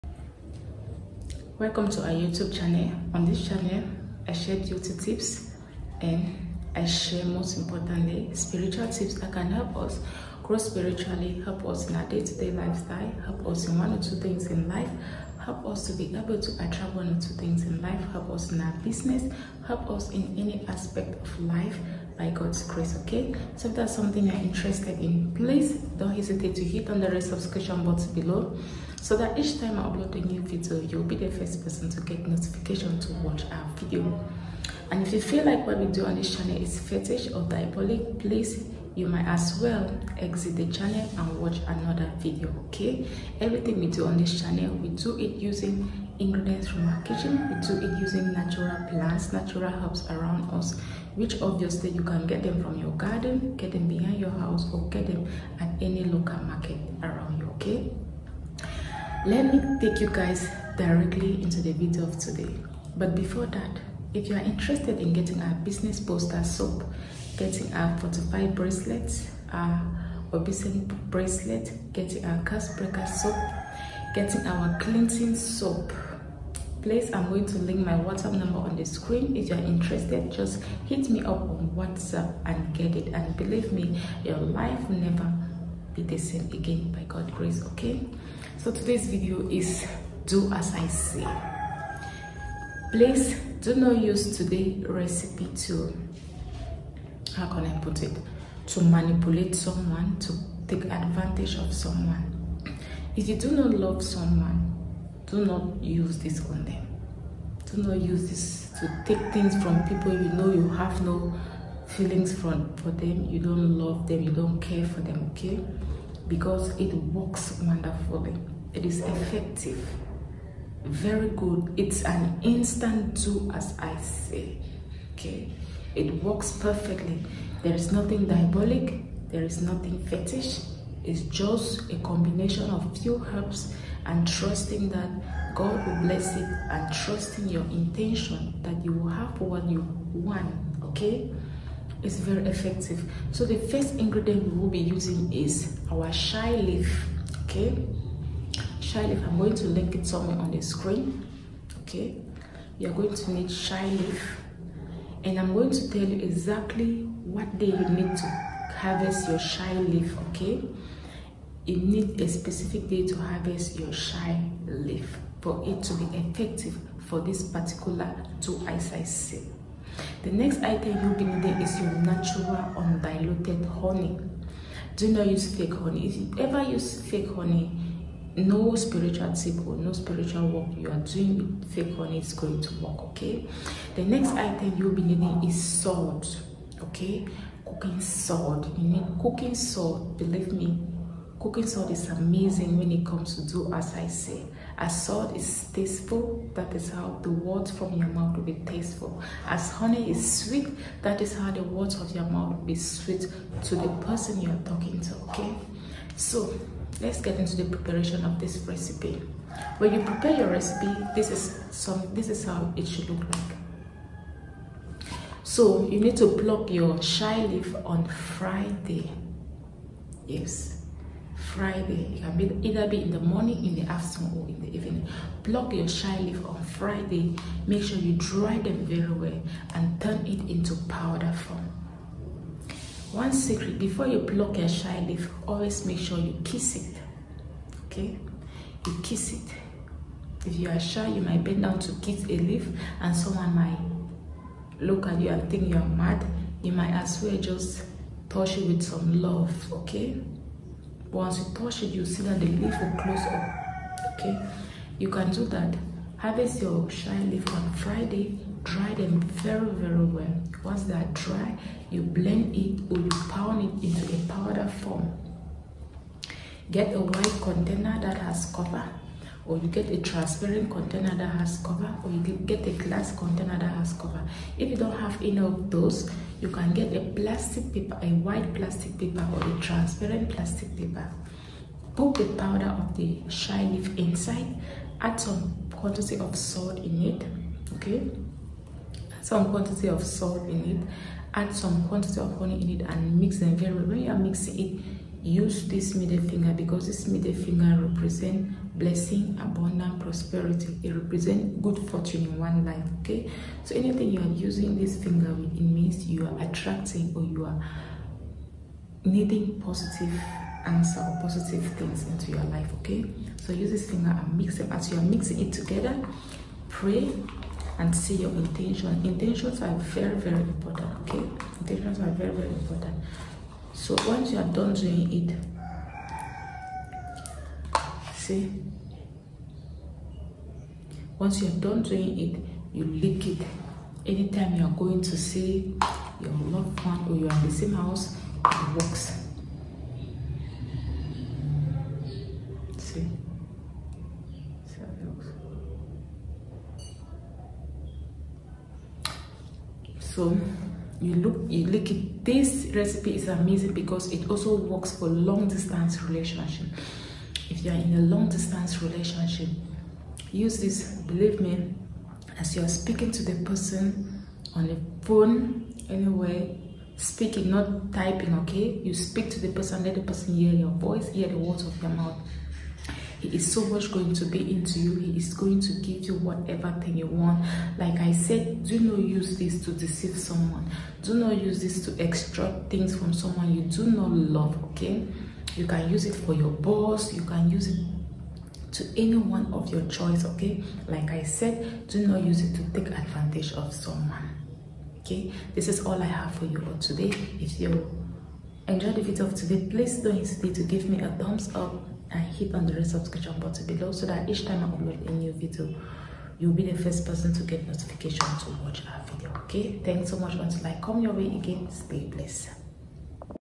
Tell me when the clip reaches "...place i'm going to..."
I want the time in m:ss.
1:16.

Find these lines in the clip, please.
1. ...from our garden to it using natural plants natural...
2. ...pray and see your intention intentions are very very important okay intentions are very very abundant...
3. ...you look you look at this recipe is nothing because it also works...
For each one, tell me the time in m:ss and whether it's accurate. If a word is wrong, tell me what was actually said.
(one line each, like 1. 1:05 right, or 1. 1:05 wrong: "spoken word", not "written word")
1. 0:46 wrong: "kitchen", not "garden"
2. 5:16 wrong: "important", not "abundant"
3. 5:51 wrong: "amazing", not "nothing".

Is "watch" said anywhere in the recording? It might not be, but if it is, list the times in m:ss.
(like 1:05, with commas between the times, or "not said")
0:33, 0:41, 6:48.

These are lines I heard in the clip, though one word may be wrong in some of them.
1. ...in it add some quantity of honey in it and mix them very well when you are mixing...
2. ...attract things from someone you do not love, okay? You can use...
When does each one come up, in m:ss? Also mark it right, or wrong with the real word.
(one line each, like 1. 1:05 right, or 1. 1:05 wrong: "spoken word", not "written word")
1. 4:50 right
2. 6:22 wrong: "extract", not "attract".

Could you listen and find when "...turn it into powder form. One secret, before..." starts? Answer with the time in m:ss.
3:49.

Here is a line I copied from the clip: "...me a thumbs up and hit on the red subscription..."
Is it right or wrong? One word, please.
right.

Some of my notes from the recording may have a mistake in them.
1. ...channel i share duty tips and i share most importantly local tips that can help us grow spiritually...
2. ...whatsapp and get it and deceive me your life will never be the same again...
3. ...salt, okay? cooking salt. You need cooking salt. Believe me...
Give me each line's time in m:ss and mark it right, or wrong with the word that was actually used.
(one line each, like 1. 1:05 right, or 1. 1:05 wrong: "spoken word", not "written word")
1. 0:03 wrong: "spiritual", not "local"
2. 1:21 wrong: "believe", not "deceive"
3. 3:05 right.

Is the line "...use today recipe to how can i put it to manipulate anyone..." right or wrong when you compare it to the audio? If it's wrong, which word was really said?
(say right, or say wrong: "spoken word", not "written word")
wrong: "someone", not "anyone".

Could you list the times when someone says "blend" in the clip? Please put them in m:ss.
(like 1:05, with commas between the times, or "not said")
4:22.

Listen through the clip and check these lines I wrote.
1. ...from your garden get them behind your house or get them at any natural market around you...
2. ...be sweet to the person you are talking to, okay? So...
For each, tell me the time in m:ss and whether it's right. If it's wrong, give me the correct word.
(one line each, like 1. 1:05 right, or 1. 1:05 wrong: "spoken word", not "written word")
1. 0:52 wrong: "local", not "natural"
2. 3:22 right.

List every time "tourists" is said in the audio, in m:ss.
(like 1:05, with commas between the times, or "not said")
not said.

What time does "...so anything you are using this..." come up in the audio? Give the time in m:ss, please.
5:03.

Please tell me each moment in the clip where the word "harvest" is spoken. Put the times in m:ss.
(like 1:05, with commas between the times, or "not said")
2:38, 2:43, 4:16.